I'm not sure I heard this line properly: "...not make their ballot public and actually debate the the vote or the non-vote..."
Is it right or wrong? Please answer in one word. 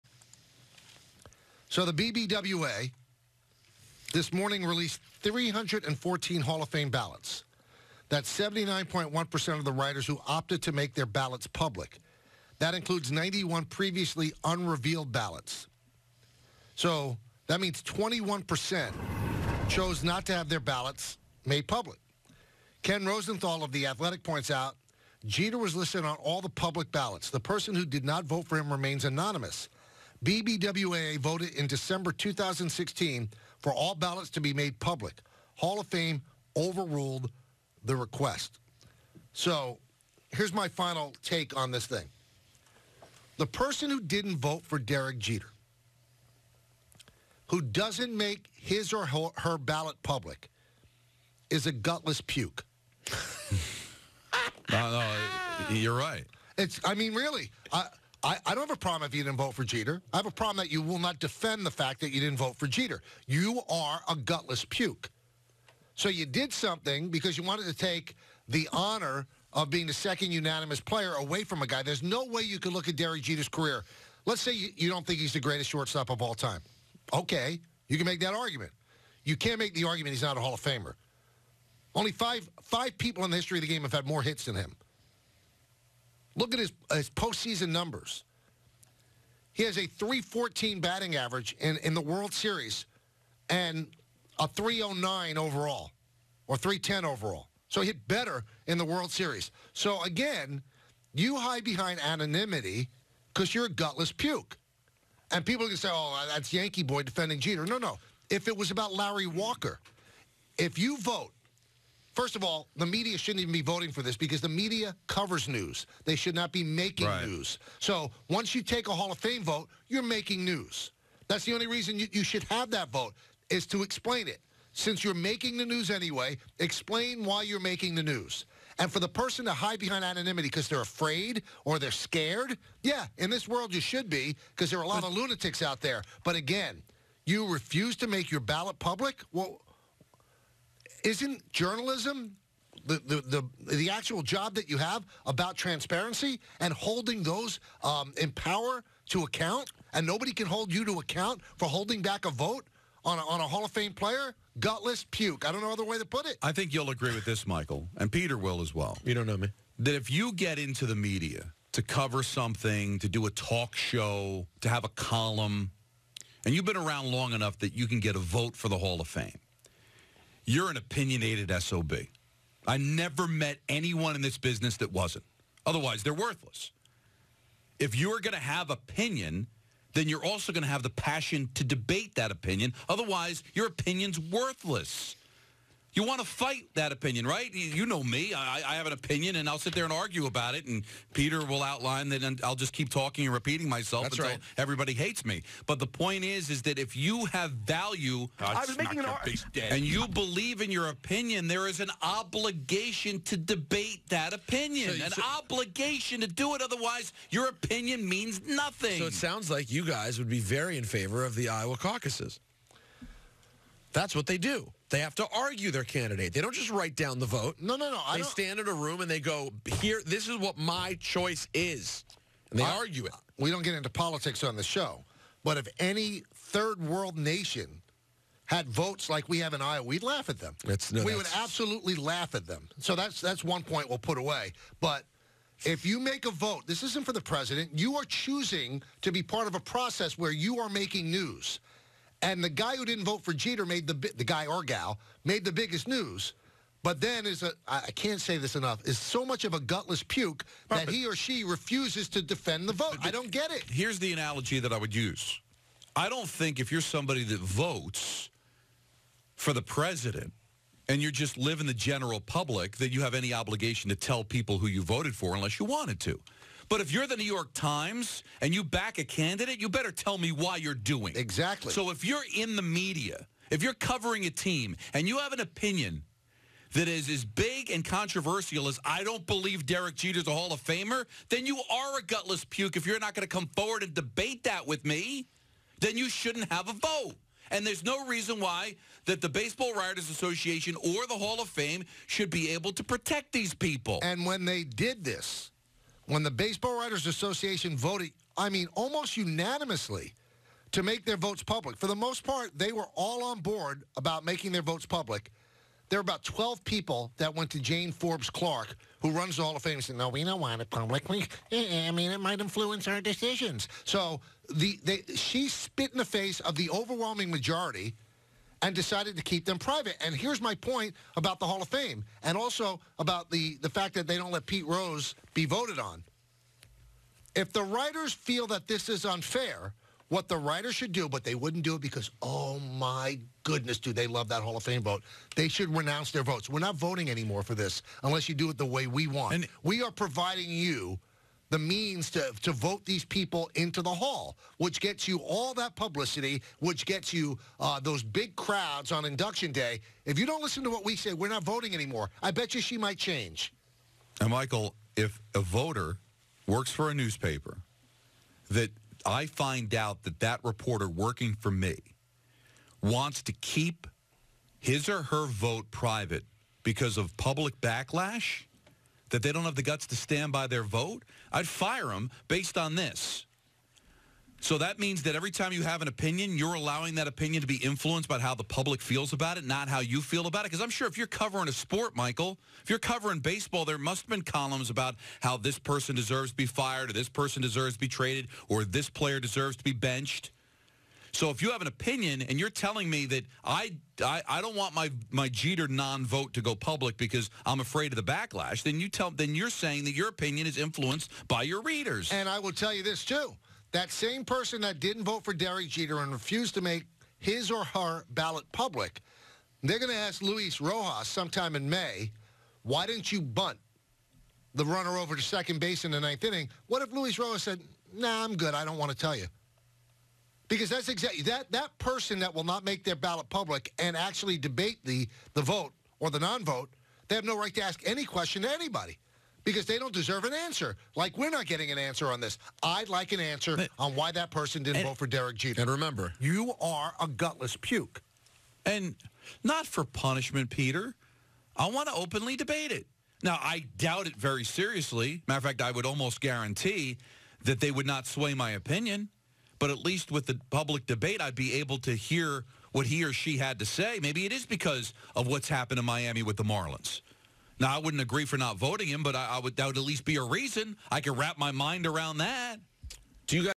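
right.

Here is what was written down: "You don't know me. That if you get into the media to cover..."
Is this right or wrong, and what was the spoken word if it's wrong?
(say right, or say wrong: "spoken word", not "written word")
right.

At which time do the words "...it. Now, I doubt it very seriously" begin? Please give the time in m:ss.
7:22.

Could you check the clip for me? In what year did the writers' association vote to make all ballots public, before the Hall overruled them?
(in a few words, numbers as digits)
2016.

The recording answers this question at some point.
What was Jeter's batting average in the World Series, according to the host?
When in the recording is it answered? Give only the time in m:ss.
1:29.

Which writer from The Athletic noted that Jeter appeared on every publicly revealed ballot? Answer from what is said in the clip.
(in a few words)
Ken Rosenthal.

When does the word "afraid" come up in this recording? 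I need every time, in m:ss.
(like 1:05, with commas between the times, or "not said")
2:10, 6:37.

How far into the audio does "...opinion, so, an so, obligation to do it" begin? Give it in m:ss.
3:24.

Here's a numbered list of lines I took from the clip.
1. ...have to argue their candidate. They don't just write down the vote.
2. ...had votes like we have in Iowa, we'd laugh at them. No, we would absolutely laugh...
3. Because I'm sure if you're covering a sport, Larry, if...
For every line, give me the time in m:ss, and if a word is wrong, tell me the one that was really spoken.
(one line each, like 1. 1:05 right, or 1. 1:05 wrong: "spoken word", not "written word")
1. 3:34 right
2. 3:48 right
3. 6:20 wrong: "Michael", not "Larry".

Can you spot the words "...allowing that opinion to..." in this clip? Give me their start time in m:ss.
6:16.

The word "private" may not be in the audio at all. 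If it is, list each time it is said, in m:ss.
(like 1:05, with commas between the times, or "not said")
5:19, 6:05.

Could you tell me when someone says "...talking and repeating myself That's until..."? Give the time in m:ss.
3:12.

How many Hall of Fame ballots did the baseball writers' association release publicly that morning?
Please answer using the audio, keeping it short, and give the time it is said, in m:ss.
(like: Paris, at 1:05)
314, at 0:05.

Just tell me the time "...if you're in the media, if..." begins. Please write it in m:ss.
4:31.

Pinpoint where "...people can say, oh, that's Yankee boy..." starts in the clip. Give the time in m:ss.
1:45.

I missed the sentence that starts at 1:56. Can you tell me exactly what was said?
They should not be making right.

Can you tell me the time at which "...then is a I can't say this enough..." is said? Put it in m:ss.
4:07.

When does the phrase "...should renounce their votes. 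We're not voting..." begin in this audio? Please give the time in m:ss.
5:35.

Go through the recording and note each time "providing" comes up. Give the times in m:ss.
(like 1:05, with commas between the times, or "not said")
5:39.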